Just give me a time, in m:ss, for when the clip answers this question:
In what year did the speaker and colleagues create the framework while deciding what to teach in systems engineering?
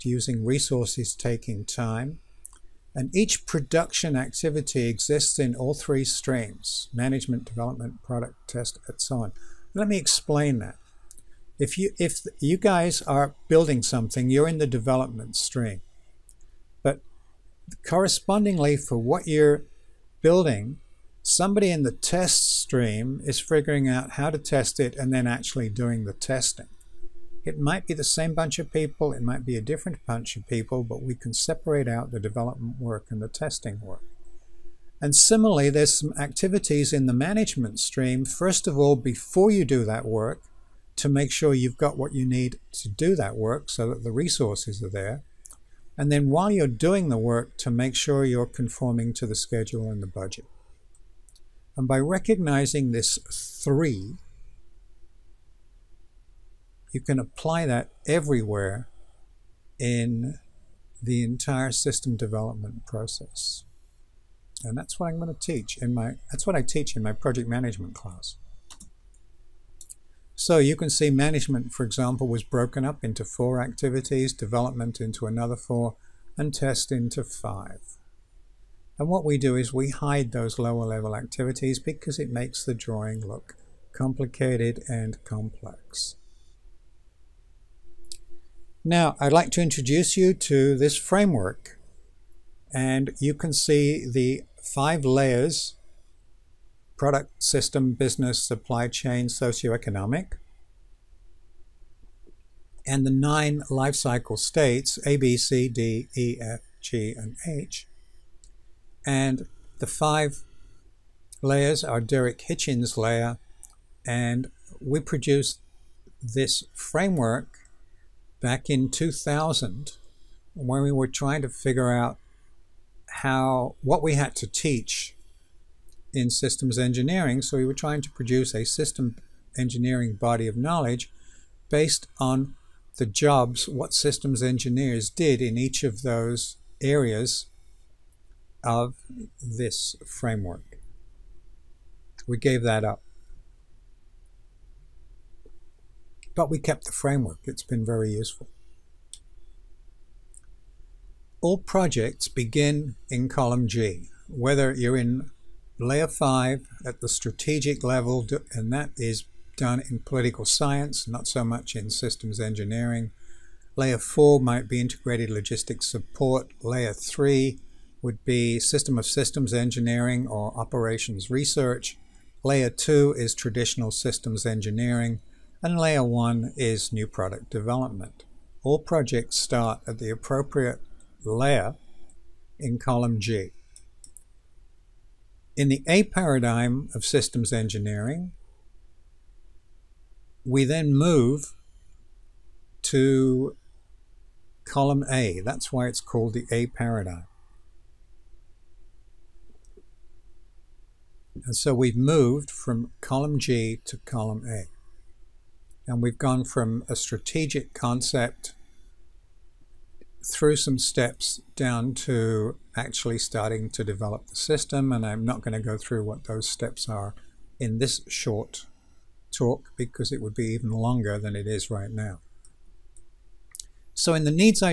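1:58.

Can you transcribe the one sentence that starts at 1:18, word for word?
And what we do is we hide those lower level activities because it makes the drawing look complicated and complex.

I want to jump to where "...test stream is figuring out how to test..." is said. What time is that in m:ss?
0:21.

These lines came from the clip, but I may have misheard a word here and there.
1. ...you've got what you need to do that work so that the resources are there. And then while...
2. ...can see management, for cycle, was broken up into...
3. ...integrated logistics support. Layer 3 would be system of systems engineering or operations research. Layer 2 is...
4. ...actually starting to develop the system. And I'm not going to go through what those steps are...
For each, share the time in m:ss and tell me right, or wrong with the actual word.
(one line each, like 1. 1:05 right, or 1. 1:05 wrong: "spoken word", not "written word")
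1. 0:41 right
2. 1:10 wrong: "example", not "cycle"
3. 2:44 right
4. 3:32 right.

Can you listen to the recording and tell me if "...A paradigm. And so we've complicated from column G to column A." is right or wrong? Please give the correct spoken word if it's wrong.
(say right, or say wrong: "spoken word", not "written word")
wrong: "moved", not "complicated".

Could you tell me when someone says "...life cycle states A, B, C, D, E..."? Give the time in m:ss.
1:43.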